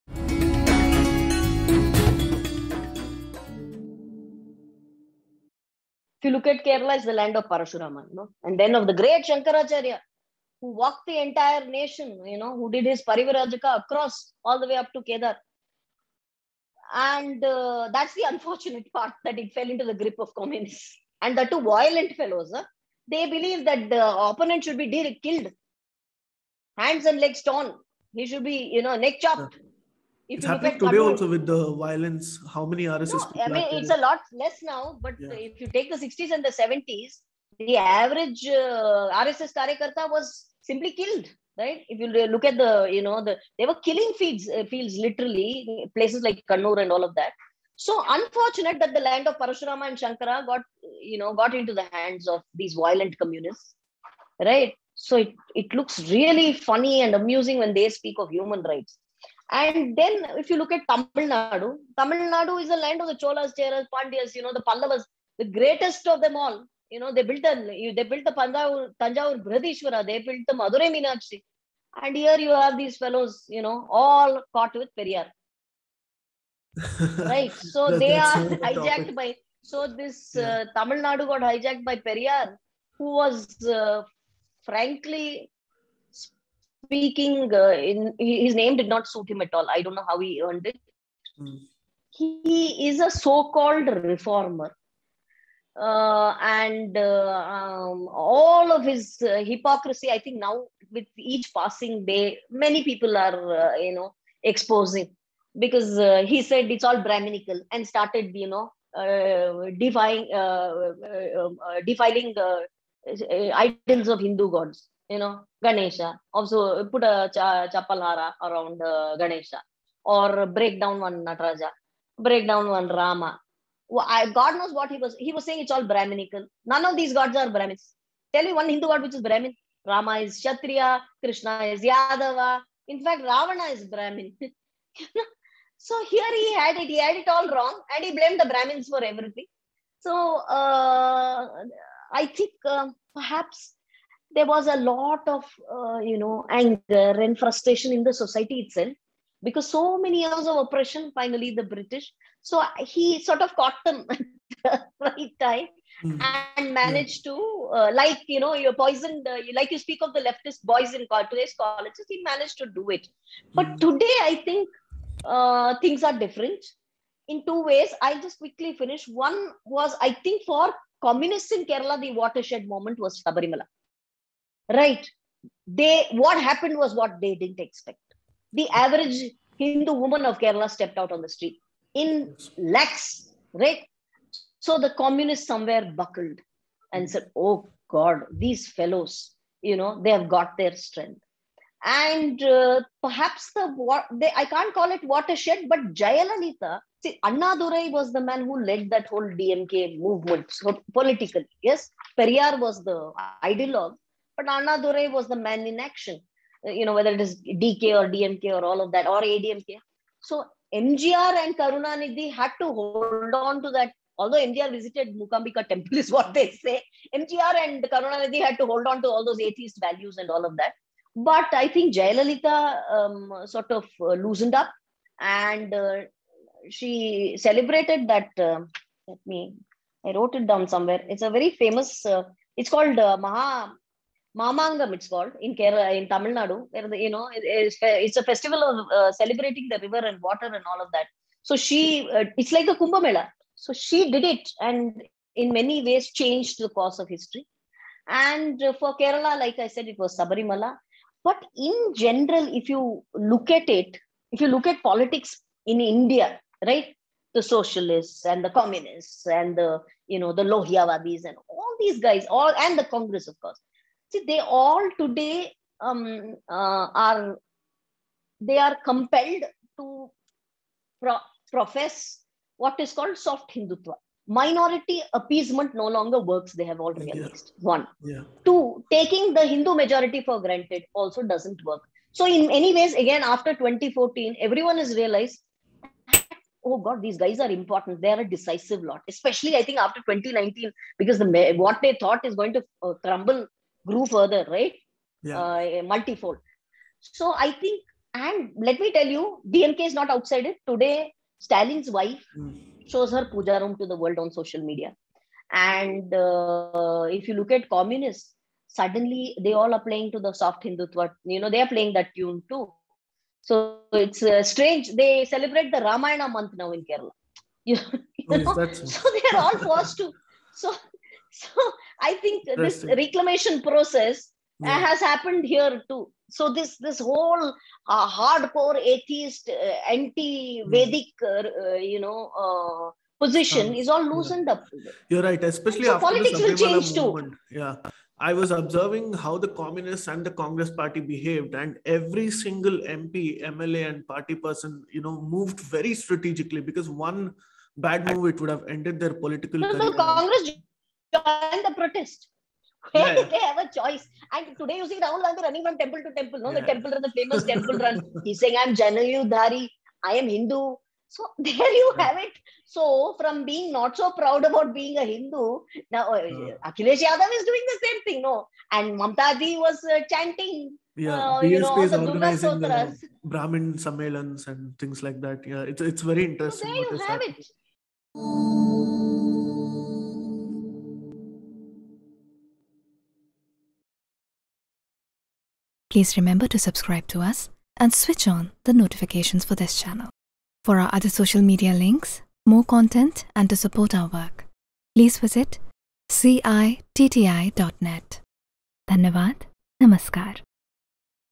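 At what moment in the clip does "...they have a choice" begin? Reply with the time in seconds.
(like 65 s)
353 s.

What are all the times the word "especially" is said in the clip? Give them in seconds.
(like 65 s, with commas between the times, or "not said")
289 s, 335 s.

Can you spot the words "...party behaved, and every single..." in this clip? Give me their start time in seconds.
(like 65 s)
340 s.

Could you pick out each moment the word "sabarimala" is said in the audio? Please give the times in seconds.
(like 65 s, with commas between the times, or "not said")
173 s, 250 s.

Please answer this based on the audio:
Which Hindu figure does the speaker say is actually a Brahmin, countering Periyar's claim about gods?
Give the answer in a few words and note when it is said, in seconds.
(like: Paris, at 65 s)
Ravana, at 133 s.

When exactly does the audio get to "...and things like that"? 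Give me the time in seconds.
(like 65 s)
374 s.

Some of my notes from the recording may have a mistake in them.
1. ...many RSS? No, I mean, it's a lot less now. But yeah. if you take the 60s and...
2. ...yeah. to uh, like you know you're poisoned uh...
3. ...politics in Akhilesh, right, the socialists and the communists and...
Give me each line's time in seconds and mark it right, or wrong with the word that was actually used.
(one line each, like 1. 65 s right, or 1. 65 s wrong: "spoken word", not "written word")
1. 32 s right
2. 157 s right
3. 254 s wrong: "India", not "Akhilesh".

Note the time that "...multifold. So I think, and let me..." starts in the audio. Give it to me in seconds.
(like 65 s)
295 s.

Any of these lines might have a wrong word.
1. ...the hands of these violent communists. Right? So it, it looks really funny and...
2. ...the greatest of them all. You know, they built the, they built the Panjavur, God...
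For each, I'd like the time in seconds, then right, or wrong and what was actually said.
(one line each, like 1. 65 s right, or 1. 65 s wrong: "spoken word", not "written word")
1. 51 s right
2. 65 s wrong: "Tanjavur", not "God".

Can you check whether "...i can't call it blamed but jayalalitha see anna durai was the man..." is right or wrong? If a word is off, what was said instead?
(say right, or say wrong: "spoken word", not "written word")
wrong: "watershed", not "blamed".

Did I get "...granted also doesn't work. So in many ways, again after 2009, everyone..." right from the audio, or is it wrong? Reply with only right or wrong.
wrong.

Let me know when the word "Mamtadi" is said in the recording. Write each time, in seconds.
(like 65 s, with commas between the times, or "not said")
368 s.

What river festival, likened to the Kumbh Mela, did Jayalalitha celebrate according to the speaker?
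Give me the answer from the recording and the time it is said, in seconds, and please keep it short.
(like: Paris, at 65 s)
Maha Mamangam, at 233 s.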